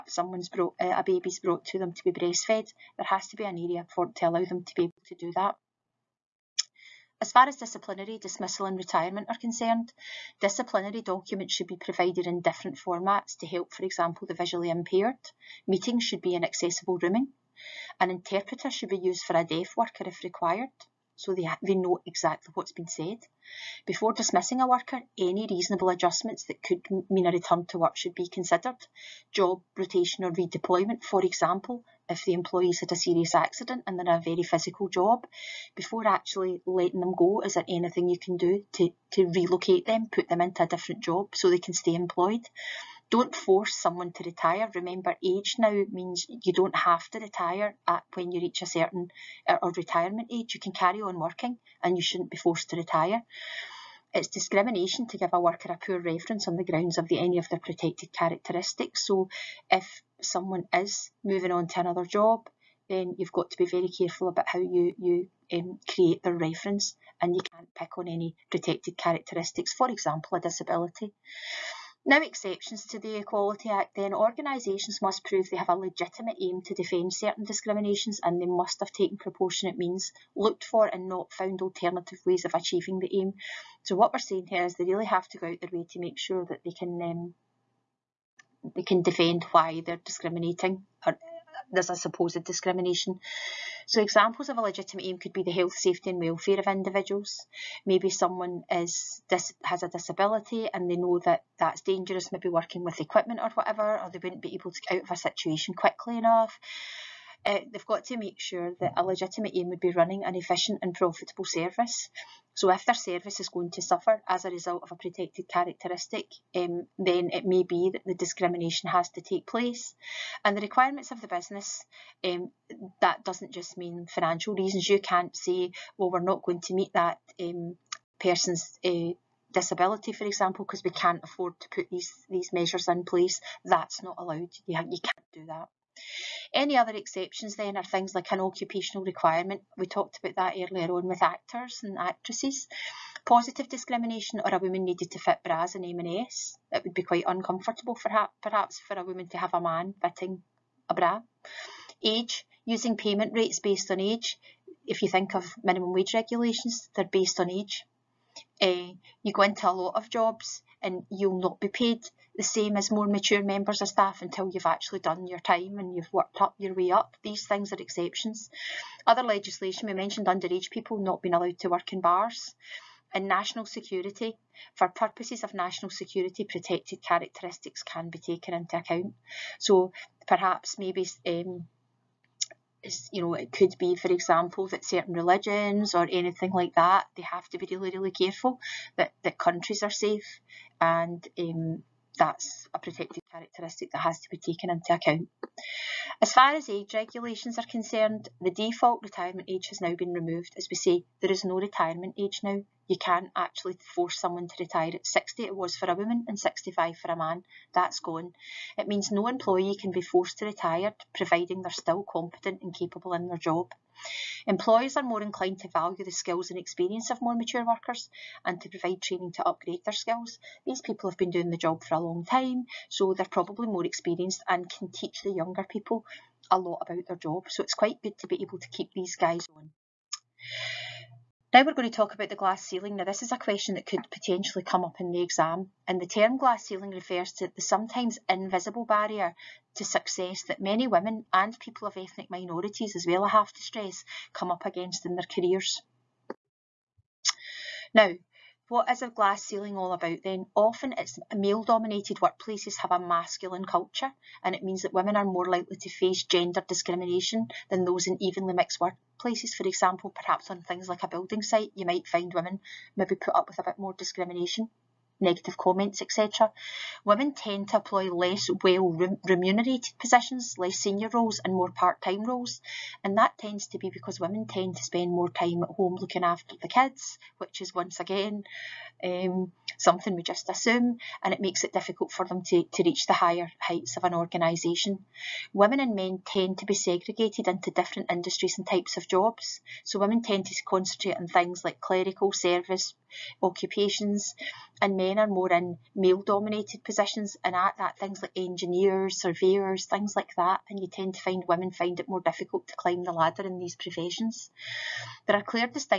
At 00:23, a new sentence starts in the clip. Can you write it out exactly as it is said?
Before dismissing a worker, any reasonable adjustments that could mean a return to work should be considered.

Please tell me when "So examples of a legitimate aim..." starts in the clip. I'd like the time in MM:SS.
01:33.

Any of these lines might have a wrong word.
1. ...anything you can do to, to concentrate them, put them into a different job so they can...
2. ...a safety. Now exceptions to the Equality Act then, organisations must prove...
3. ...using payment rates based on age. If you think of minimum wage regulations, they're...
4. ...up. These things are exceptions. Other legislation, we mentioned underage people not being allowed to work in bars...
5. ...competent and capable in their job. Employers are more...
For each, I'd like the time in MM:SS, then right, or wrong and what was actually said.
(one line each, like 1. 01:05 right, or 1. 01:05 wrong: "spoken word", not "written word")
1. 00:37 wrong: "relocate", not "concentrate"
2. 01:10 wrong: "disability", not "safety"
3. 02:32 right
4. 02:46 right
5. 03:32 right.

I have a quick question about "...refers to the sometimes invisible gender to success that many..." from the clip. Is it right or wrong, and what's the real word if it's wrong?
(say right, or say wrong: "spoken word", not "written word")
wrong: "barrier", not "gender".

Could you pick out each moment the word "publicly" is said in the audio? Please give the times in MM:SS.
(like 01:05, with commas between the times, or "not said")
not said.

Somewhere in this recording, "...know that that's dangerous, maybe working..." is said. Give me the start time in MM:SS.
01:40.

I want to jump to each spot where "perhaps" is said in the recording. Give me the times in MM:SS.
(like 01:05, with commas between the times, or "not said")
02:28, 03:00, 04:20.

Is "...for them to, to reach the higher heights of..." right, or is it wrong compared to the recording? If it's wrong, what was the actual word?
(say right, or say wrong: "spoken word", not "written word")
right.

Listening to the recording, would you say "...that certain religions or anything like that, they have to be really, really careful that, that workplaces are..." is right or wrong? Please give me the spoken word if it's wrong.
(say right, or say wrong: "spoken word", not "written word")
wrong: "countries", not "workplaces".